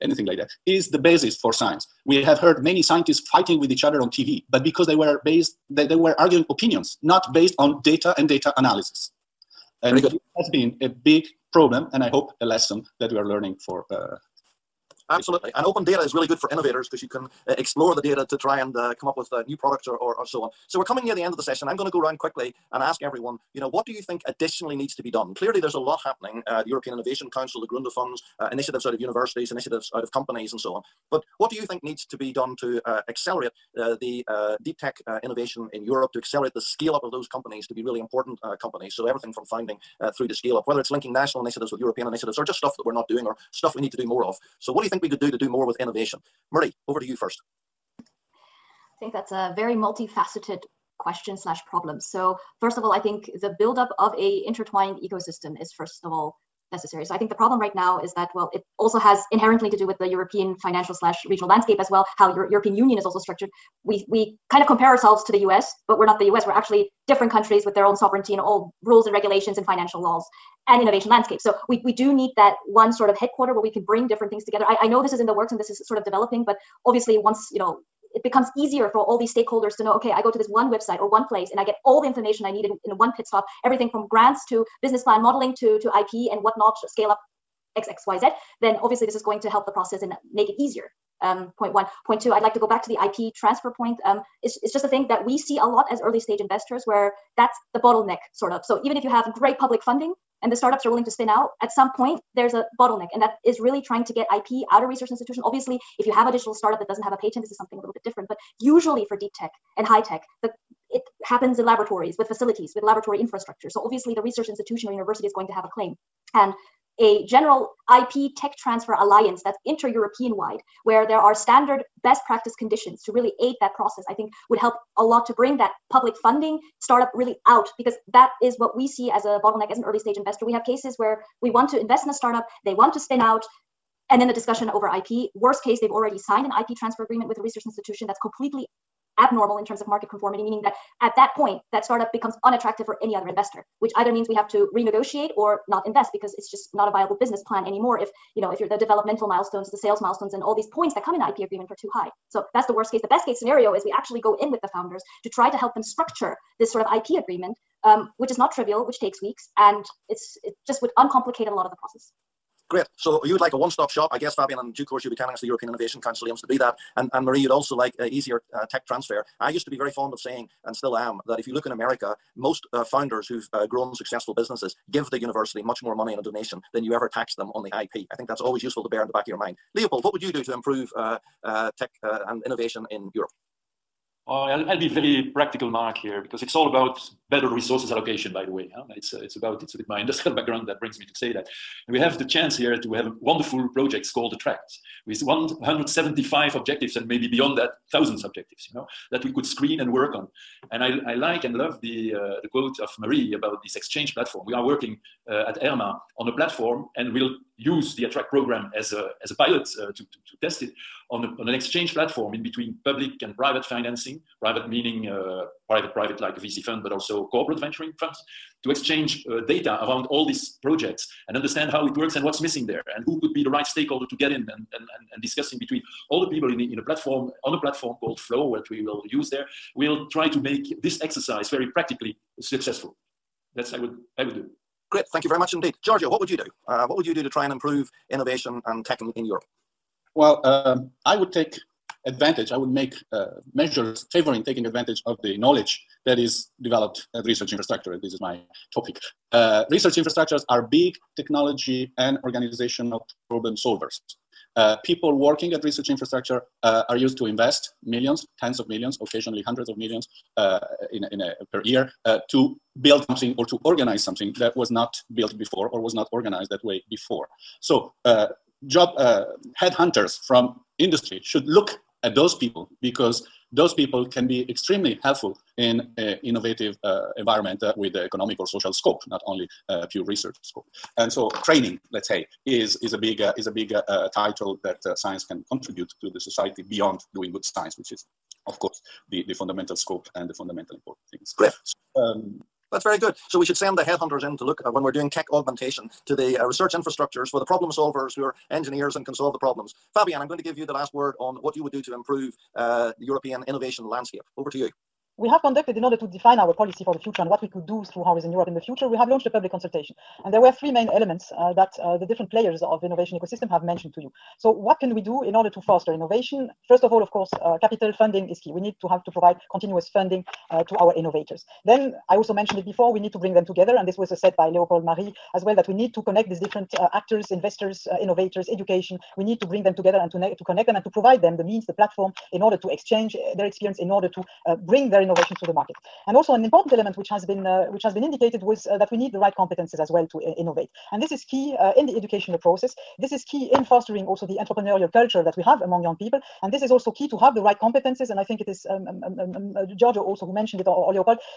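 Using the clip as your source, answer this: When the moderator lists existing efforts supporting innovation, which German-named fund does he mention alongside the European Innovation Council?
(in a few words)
Gründerfonds.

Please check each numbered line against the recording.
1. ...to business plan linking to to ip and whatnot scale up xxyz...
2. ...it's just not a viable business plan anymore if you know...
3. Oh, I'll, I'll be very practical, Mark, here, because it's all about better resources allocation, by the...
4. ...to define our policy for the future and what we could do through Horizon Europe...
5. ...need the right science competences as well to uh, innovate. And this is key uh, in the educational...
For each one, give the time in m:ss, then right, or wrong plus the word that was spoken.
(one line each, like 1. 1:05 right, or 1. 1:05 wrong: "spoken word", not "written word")
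1. 1:24 wrong: "modeling", not "linking"
2. 2:26 right
3. 3:04 right
4. 5:05 right
5. 5:38 wrong: "competence", not "science".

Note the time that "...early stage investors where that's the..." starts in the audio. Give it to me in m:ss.
1:36.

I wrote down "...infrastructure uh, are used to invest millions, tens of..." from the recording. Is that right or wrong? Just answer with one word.
right.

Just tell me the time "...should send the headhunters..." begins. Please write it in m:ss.
4:53.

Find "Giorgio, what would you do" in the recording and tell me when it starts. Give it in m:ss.
3:55.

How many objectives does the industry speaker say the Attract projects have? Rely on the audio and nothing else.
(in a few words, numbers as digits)
175.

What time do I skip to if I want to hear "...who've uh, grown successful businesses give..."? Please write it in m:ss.
2:53.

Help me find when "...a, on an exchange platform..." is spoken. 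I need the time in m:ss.
3:31.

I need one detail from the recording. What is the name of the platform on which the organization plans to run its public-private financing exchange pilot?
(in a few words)
Flow.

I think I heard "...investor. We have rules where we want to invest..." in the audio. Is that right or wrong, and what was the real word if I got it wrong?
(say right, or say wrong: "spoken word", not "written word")
wrong: "cases", not "rules".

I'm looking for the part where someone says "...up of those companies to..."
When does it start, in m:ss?
0:36.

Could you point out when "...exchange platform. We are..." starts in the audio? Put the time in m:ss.
3:23.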